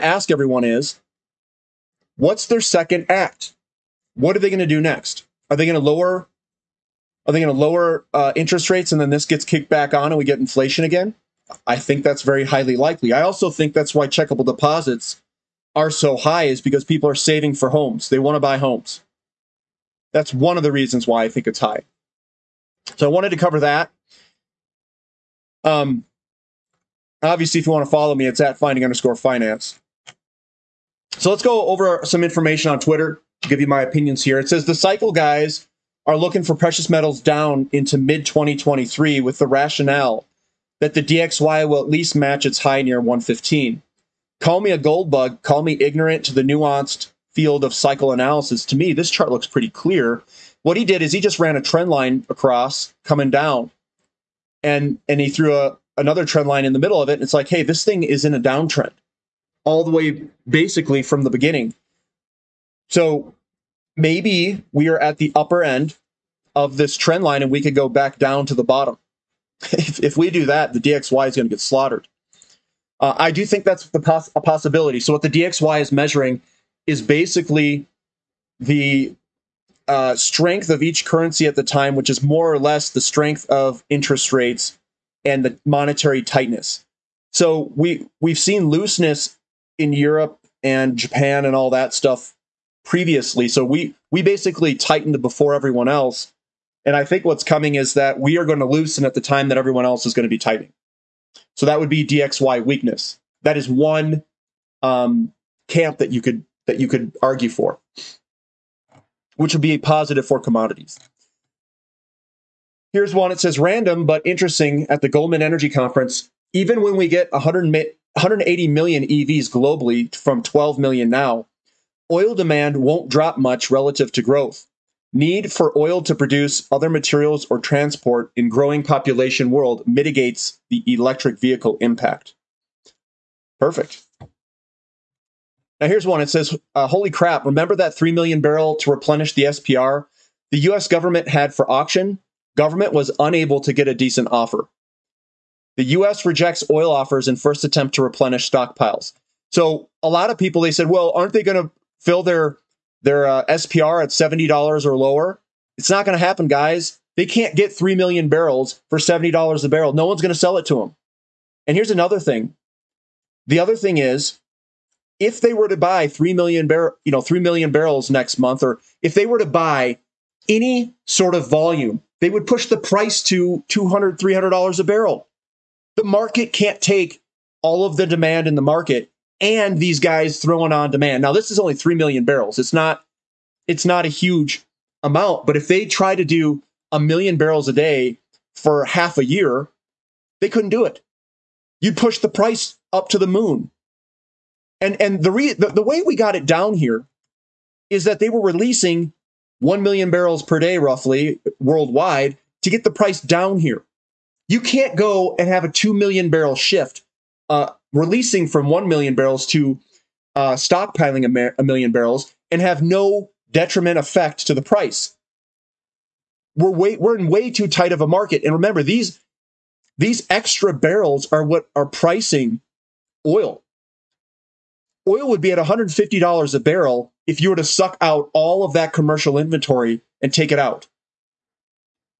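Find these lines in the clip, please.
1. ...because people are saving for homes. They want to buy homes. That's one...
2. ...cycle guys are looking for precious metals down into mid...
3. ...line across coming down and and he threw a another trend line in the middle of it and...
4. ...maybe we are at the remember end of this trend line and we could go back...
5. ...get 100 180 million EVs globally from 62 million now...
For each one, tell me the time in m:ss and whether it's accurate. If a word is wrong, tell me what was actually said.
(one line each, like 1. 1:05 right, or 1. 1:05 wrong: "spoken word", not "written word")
1. 0:16 right
2. 0:34 right
3. 0:51 right
4. 1:03 wrong: "upper", not "remember"
5. 1:57 wrong: "12", not "62".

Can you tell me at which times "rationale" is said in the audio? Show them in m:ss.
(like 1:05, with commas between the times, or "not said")
0:39.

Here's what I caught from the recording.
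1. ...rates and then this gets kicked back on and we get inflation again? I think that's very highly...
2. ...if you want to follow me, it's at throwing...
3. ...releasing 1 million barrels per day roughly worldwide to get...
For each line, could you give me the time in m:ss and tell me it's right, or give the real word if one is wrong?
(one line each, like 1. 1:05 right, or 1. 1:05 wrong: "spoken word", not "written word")
1. 0:08 right
2. 0:27 wrong: "finding", not "throwing"
3. 3:18 right.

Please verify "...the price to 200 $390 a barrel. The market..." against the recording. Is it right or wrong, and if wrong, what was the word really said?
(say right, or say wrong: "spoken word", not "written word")
wrong: "300", not "390".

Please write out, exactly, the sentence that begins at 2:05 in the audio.
Need for oil to produce other materials or transport in growing population world mitigates the electric vehicle impact.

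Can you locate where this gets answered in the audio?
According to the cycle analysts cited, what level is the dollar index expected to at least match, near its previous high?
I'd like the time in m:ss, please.
0:43.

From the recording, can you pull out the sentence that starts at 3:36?
We're, way, we're in way too tight of a market.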